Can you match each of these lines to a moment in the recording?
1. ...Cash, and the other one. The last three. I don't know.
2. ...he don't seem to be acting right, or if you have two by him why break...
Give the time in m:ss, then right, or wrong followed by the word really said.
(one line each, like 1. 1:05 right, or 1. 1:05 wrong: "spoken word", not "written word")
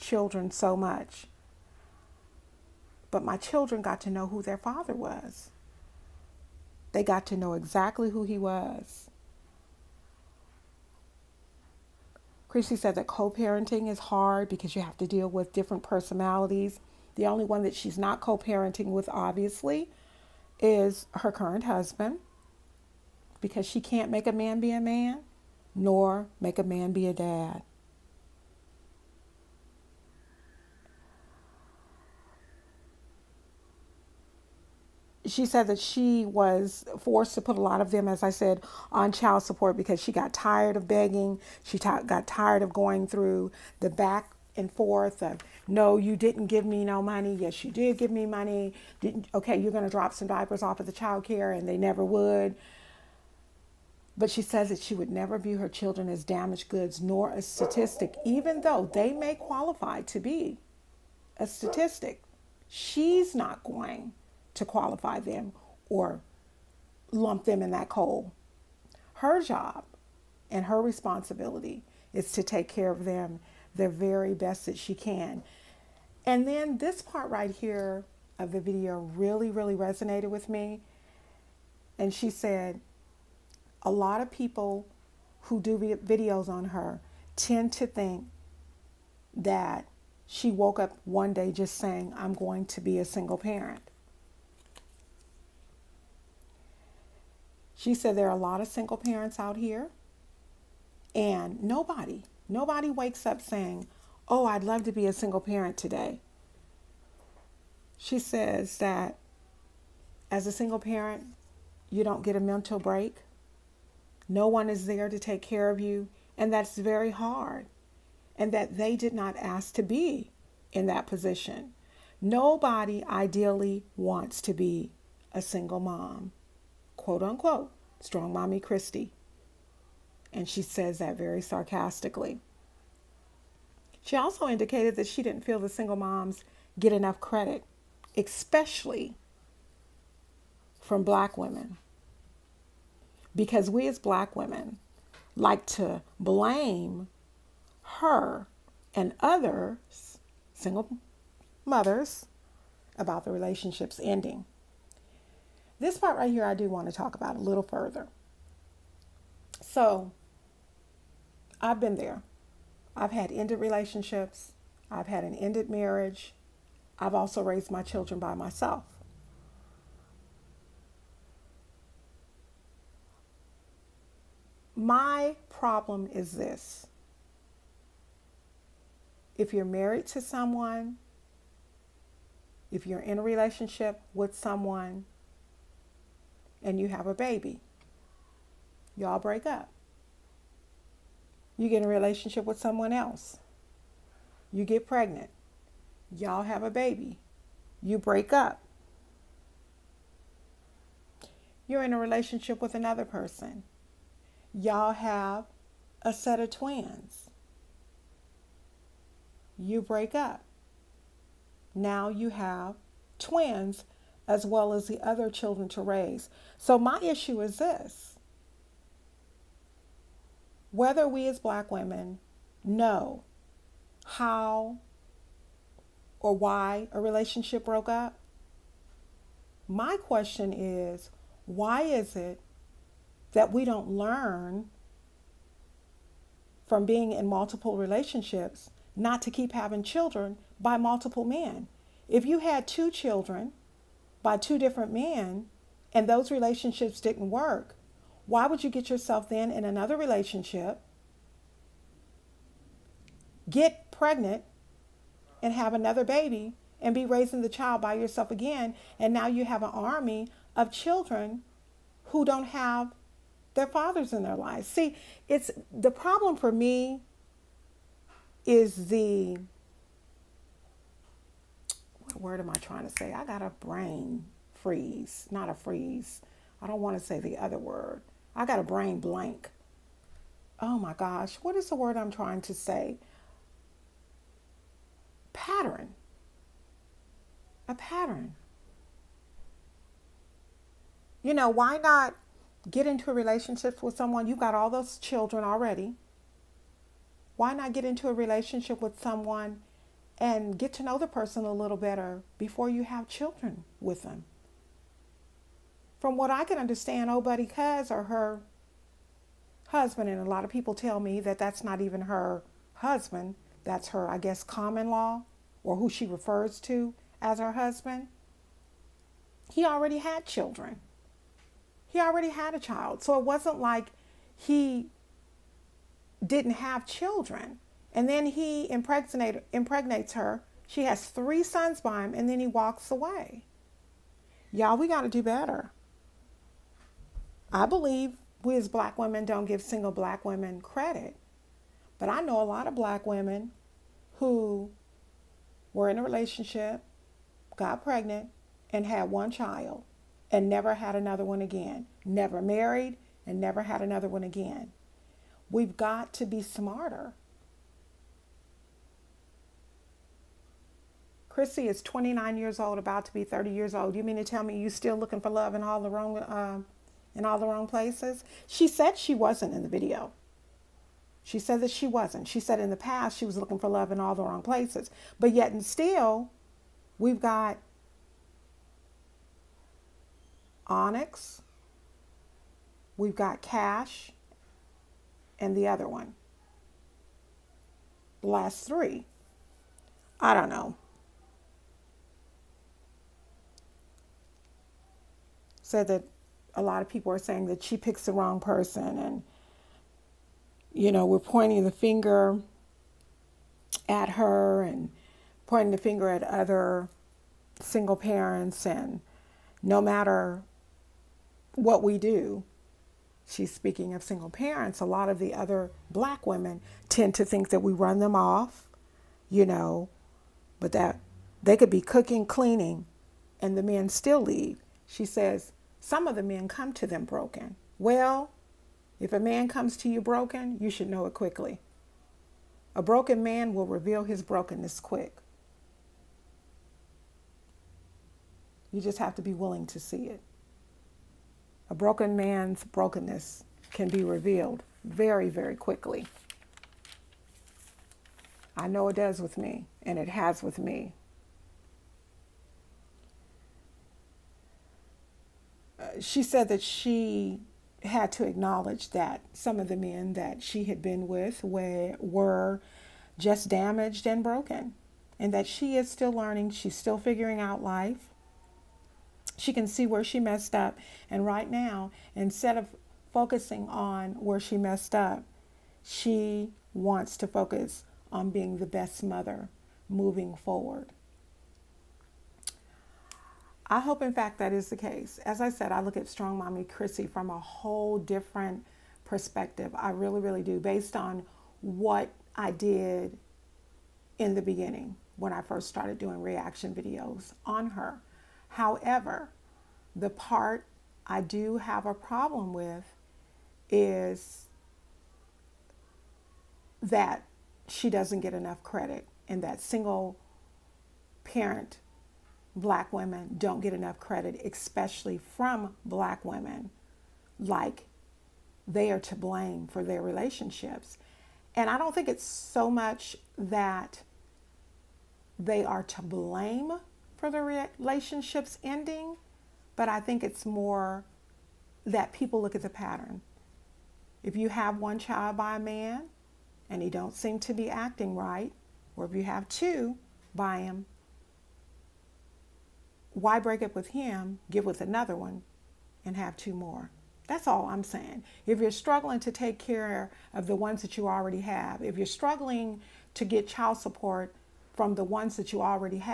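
1. 6:23 right
2. 8:56 right.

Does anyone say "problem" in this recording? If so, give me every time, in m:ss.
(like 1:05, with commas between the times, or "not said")
2:55, 4:25, 8:21.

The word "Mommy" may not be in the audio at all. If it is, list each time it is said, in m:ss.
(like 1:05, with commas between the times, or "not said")
2:08, 8:06.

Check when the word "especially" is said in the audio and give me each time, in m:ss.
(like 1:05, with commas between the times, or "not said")
2:18, 8:34.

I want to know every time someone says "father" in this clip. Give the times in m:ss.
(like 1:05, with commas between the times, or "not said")
0:04, 4:23.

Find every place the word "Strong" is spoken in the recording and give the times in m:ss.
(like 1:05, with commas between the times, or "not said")
2:08, 8:06.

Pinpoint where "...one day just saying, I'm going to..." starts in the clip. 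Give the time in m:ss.
1:31.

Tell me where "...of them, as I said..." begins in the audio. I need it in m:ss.
0:37.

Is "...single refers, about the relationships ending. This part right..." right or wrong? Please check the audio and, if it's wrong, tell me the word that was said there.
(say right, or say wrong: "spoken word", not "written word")
wrong: "mothers", not "refers".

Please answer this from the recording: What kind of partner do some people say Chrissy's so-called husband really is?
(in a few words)
common law.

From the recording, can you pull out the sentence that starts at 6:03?
You mean to tell me you are still looking for love in all the wrong, uh, in all the wrong places?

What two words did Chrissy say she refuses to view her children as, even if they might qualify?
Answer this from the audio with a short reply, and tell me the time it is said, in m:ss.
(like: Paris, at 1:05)
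damaged goods, at 0:56.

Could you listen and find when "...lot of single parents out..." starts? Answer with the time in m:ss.
1:38.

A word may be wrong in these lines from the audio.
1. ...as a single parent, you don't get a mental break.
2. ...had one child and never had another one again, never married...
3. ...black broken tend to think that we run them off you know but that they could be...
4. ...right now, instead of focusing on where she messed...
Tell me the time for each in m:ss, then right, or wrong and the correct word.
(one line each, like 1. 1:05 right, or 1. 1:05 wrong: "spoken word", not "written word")
1. 1:50 right
2. 5:48 right
3. 6:55 wrong: "women", not "broken"
4. 7:51 right.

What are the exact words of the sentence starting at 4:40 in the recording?
Oh my gosh, what is the word I'm trying to say?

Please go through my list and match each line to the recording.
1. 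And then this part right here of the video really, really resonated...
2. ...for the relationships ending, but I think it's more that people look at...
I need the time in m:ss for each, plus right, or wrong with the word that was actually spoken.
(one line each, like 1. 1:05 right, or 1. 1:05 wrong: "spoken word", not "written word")
1. 1:16 right
2. 8:47 right.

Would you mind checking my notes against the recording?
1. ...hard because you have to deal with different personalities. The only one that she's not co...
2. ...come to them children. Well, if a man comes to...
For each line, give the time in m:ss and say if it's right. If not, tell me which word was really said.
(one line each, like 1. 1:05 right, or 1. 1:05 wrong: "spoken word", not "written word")
1. 0:13 right
2. 7:06 wrong: "broken", not "children".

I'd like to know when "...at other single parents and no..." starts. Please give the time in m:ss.
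6:46.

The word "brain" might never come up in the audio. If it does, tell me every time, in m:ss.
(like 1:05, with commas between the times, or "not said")
4:33, 4:38.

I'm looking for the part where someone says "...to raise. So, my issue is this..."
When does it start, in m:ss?
3:35.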